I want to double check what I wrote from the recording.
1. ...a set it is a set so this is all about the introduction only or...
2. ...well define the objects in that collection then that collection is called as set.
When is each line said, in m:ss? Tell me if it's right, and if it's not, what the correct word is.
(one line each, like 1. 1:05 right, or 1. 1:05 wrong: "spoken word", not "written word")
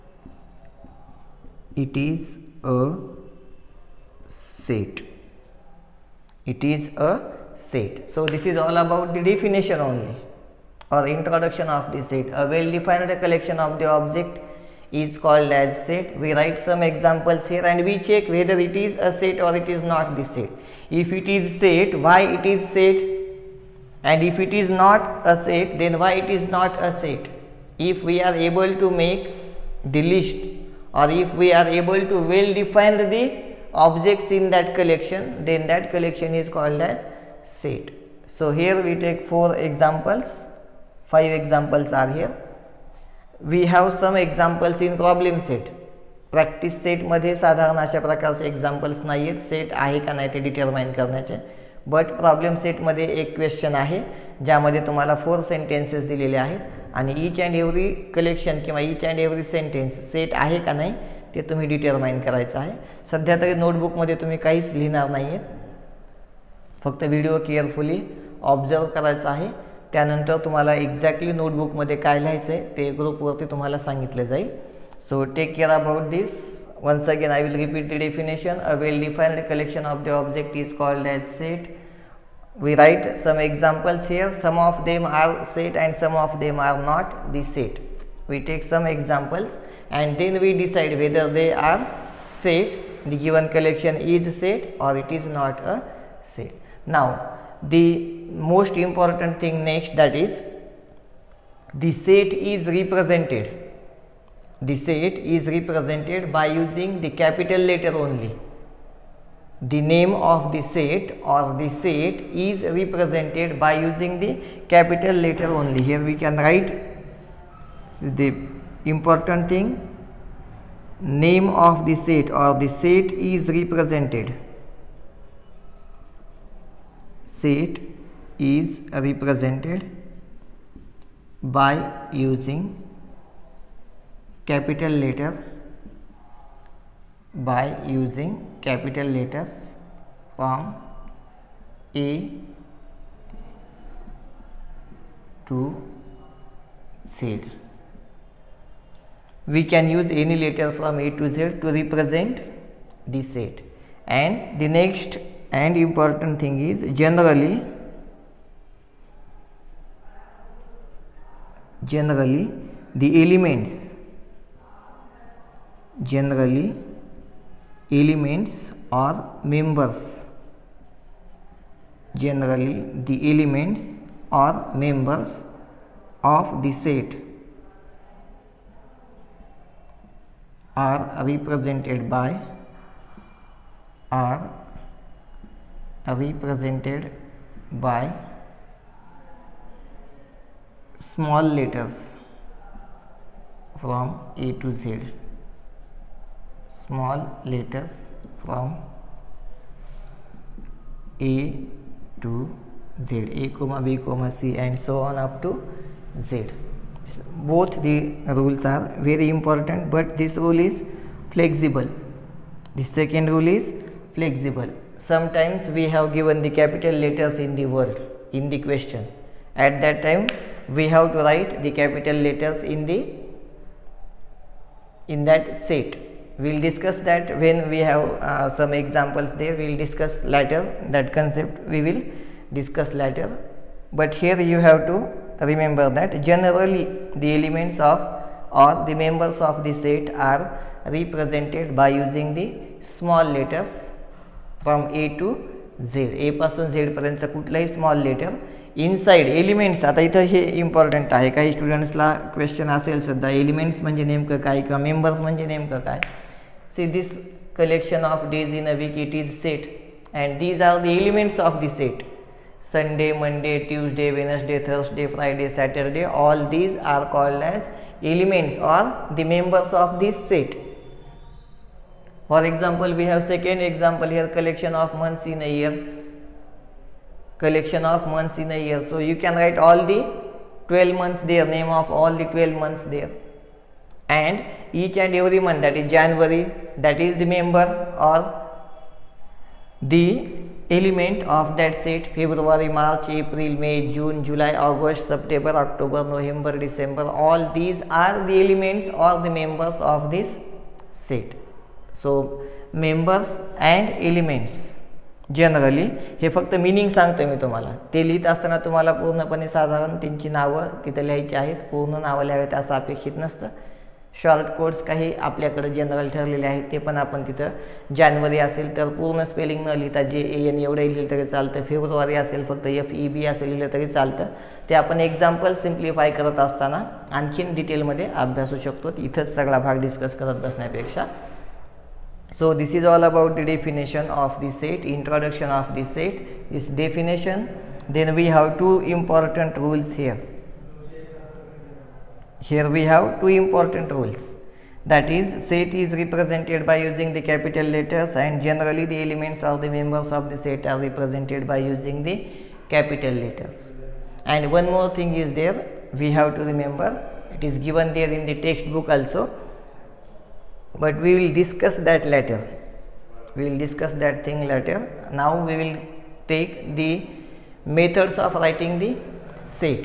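1. 0:02 wrong: "definition", not "introduction"
2. 0:32 right.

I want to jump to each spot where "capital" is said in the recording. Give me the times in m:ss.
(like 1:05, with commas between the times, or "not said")
1:47, 1:54, 2:14, 2:18, 3:36, 3:41, 5:47, 5:52.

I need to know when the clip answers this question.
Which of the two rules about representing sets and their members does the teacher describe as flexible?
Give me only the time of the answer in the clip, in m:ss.
3:32.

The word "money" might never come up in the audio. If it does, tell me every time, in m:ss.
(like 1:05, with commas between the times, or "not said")
not said.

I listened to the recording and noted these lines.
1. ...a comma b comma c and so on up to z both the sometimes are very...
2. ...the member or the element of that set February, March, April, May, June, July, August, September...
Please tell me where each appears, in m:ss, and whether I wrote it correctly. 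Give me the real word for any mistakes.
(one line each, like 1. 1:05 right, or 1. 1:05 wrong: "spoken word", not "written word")
1. 3:23 wrong: "rules", not "sometimes"
2. 4:47 right.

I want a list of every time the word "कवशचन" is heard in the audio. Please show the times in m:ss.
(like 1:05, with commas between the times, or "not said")
0:53, 4:12.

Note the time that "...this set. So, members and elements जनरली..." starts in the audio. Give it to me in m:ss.
5:00.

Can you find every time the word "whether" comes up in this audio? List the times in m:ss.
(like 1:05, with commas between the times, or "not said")
0:18, 1:30.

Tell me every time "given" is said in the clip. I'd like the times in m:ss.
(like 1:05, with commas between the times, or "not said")
1:33, 3:36, 5:57.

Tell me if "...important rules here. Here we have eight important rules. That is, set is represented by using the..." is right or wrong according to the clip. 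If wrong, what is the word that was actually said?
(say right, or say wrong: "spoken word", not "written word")
wrong: "two", not "eight".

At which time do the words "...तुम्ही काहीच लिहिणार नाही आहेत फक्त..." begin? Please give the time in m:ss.
1:04.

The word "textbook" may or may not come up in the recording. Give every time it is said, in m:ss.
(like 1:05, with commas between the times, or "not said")
5:58.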